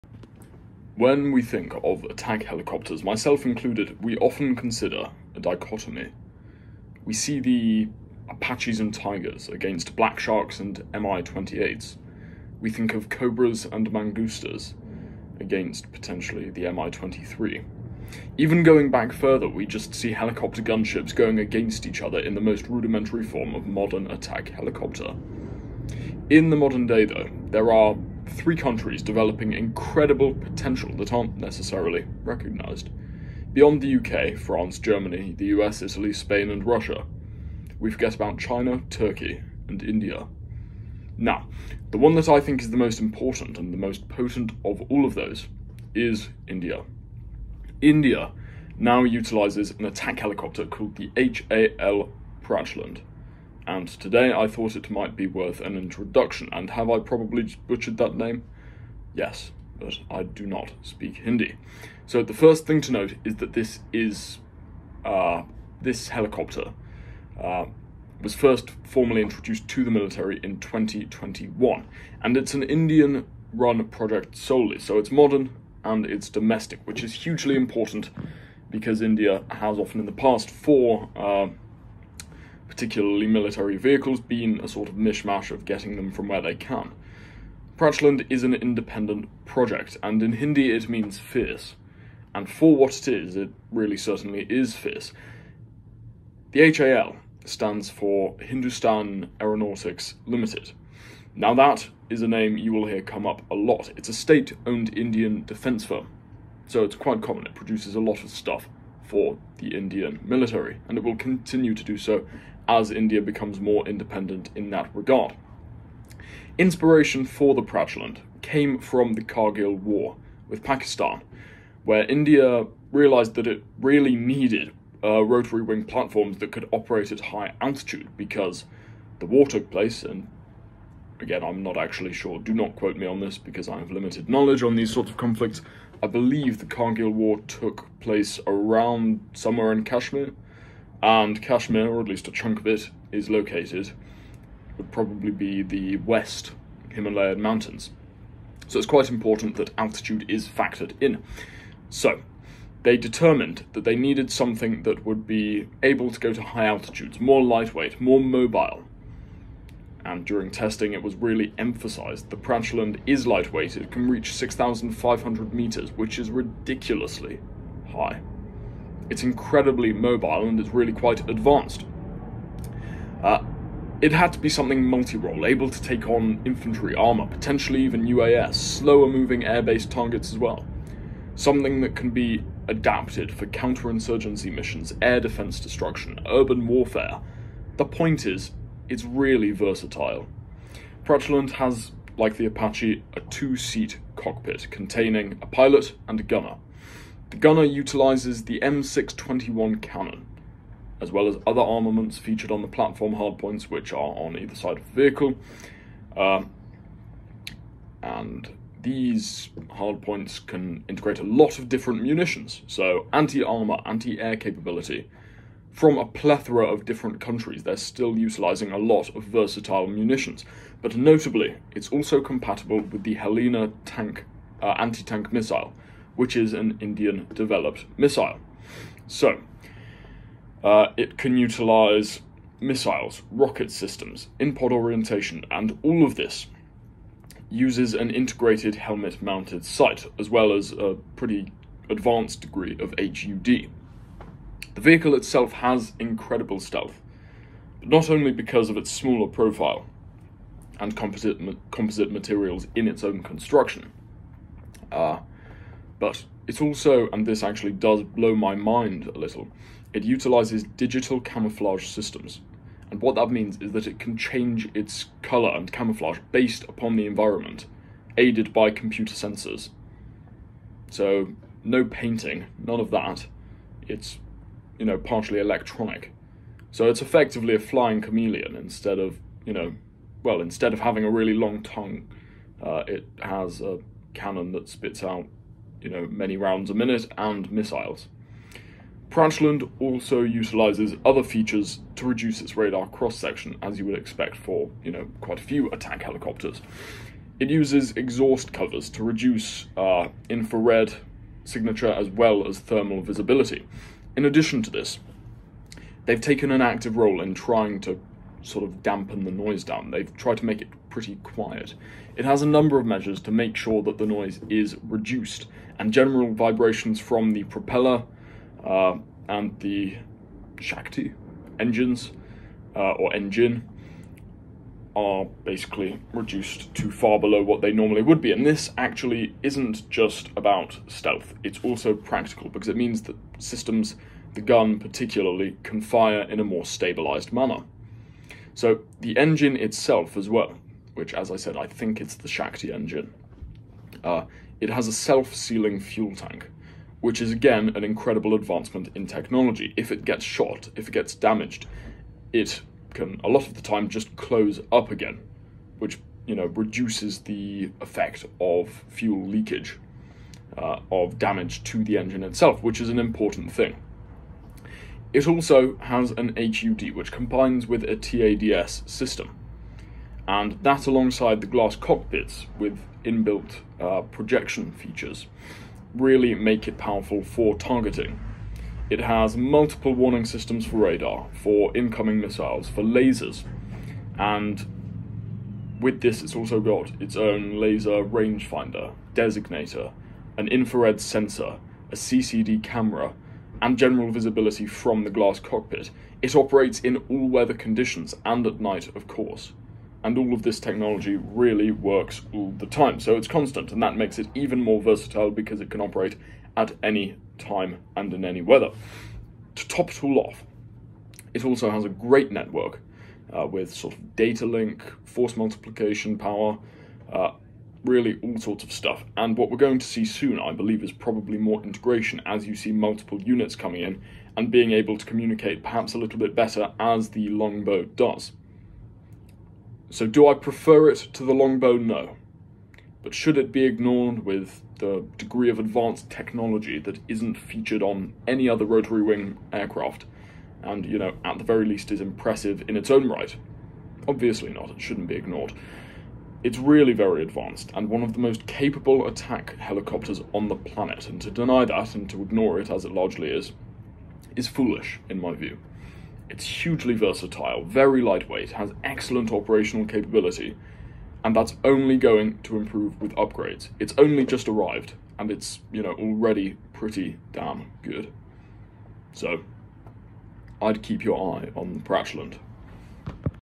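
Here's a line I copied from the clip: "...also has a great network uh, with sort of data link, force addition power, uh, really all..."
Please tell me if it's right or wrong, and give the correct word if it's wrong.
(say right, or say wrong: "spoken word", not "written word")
wrong: "multiplication", not "addition".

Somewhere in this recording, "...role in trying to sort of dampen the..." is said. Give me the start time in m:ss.
5:06.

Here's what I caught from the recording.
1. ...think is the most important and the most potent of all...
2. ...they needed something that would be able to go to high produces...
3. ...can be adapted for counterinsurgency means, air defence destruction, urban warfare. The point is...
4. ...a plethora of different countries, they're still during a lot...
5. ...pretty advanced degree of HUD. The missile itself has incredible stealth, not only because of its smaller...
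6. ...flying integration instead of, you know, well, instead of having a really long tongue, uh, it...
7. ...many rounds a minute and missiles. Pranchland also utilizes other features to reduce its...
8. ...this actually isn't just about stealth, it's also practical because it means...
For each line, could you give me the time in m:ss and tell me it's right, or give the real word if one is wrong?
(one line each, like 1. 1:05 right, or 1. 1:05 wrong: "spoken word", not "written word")
1. 0:42 right
2. 2:33 wrong: "altitudes", not "produces"
3. 3:01 wrong: "missions", not "means"
4. 3:35 wrong: "utilizing", not "during"
5. 4:01 wrong: "vehicle", not "missile"
6. 4:37 wrong: "chameleon", not "integration"
7. 4:46 right
8. 5:28 right.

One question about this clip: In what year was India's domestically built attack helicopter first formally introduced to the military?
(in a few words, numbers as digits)
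2021.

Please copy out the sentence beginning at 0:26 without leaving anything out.
In the modern day, though, there are three countries developing incredible potential that aren't necessarily recognised.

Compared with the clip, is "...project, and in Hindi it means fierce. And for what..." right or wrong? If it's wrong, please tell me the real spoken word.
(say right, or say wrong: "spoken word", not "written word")
right.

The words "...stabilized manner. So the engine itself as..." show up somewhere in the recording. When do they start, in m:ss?
5:36.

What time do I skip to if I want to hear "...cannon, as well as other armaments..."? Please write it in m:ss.
3:19.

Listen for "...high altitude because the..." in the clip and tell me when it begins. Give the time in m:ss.
2:07.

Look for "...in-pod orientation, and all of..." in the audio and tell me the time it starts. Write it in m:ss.
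3:54.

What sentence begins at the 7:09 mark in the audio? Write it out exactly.
So do I prefer it to the longbow?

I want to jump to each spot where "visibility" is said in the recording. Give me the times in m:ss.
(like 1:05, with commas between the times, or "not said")
5:03, 6:34.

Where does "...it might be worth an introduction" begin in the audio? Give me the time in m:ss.
0:54.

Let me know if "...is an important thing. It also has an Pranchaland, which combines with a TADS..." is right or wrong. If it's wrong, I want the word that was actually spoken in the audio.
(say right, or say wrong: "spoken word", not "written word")
wrong: "HUD", not "Pranchaland".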